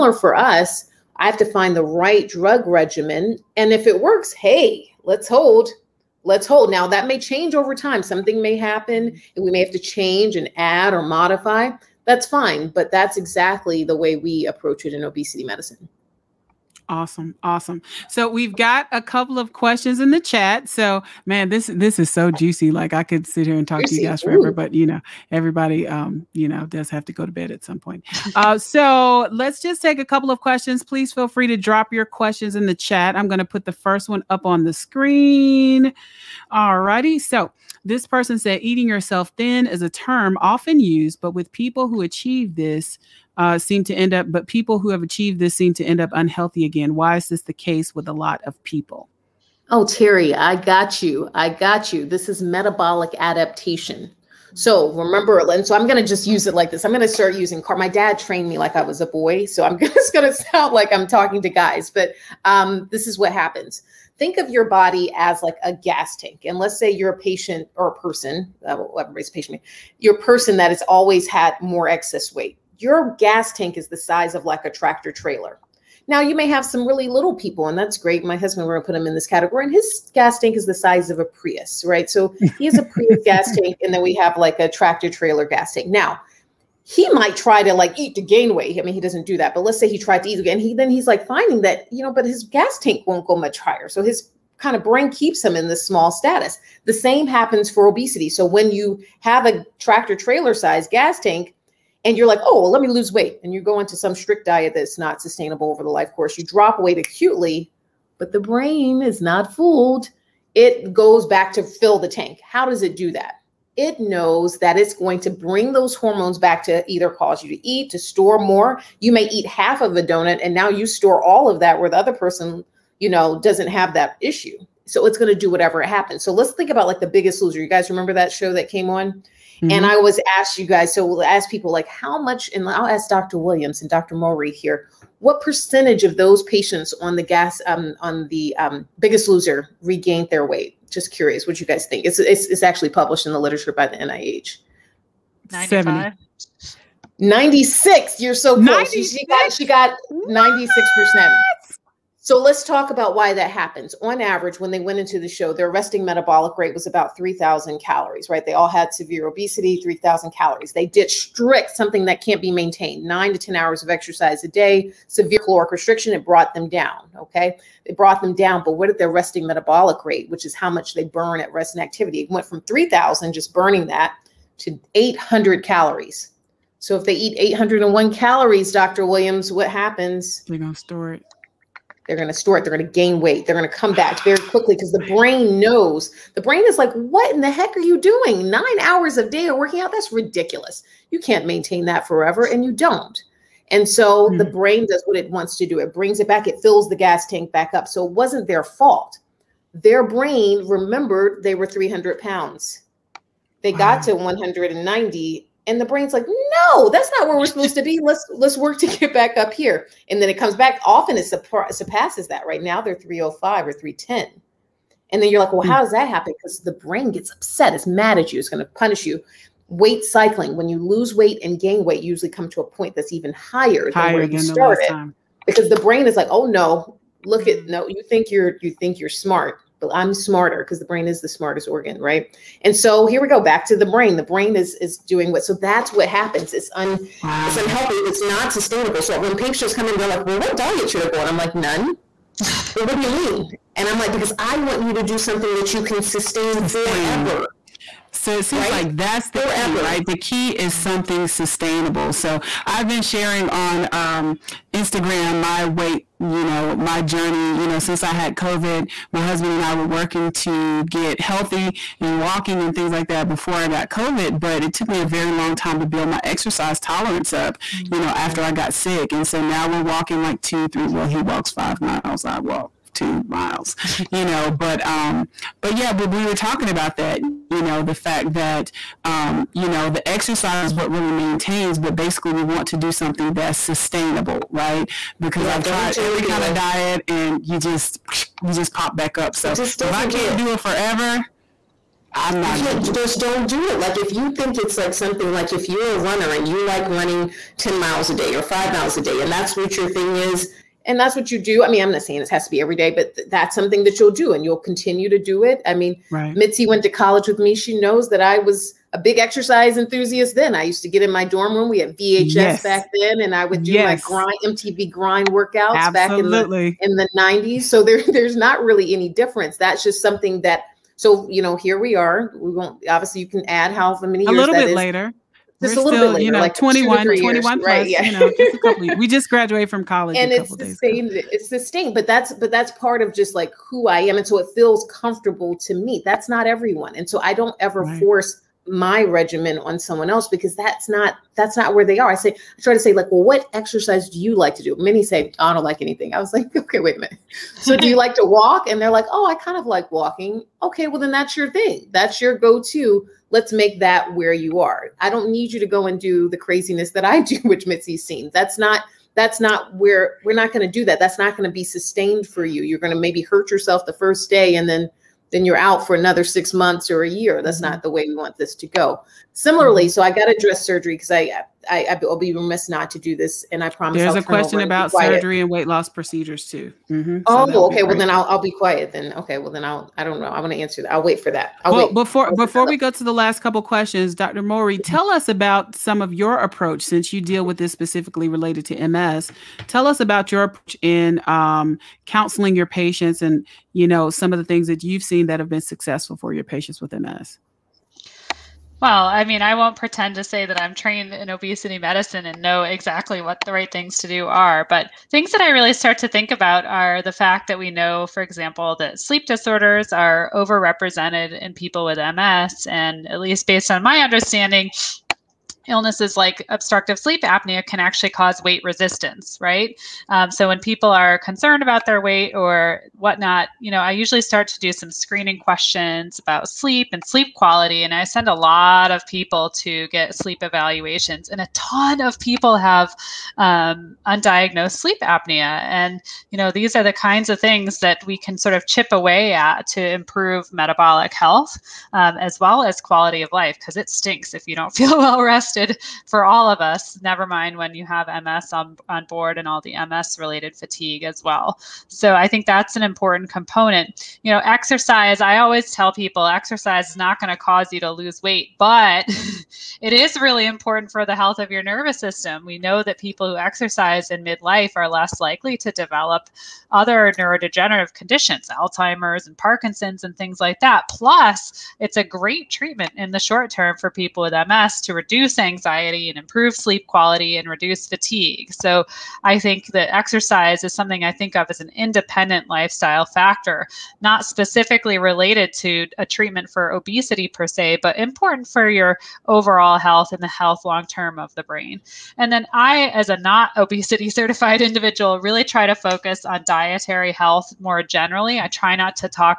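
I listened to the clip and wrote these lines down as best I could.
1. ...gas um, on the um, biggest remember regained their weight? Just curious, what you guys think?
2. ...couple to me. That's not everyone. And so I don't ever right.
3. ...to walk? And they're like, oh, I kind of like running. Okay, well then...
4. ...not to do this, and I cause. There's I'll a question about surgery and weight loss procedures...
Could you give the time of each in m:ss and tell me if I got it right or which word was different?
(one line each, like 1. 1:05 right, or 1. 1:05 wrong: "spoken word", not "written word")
1. 2:17 wrong: "loser", not "remember"
2. 5:34 wrong: "comfortable", not "couple"
3. 5:48 wrong: "walking", not "running"
4. 6:12 wrong: "promise", not "cause".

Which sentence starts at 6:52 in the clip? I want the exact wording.
And at least based on my understanding, illnesses like obstructive sleep apnea can actually cause weight resistance, right?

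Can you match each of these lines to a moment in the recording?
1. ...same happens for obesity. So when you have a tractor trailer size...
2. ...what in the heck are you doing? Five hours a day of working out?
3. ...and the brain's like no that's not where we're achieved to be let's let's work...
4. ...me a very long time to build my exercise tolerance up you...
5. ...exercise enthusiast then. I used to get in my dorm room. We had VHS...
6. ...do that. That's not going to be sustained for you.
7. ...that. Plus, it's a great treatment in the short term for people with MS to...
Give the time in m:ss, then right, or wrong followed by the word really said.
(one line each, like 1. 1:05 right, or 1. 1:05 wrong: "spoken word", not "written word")
1. 1:36 right
2. 3:06 wrong: "Nine", not "Five"
3. 3:25 wrong: "supposed", not "achieved"
4. 4:24 right
5. 5:09 right
6. 6:00 right
7. 7:50 right.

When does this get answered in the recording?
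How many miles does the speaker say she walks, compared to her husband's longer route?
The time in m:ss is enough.
4:32.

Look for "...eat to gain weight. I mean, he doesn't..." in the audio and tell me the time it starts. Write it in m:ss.
1:27.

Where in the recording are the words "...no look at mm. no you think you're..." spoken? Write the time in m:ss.
3:46.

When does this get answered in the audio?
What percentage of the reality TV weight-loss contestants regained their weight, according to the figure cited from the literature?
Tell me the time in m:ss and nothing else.
2:29.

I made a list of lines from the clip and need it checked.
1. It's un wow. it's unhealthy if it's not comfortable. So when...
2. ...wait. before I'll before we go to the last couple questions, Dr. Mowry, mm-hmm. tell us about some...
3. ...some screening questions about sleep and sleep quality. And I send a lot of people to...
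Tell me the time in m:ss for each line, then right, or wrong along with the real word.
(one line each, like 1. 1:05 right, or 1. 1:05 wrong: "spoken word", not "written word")
1. 3:56 wrong: "sustainable", not "comfortable"
2. 6:21 right
3. 7:04 right.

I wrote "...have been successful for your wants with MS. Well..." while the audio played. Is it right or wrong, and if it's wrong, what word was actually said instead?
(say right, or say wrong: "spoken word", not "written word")
wrong: "patients", not "wants".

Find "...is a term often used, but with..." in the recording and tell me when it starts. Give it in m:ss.
0:39.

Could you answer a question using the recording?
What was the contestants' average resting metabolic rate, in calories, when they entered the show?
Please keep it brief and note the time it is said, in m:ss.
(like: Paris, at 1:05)
3,000, at 2:36.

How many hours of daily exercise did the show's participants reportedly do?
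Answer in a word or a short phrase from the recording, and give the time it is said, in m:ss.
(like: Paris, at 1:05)
9 to 10, at 2:43.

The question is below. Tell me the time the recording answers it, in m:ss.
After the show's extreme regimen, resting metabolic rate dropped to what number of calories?
2:54.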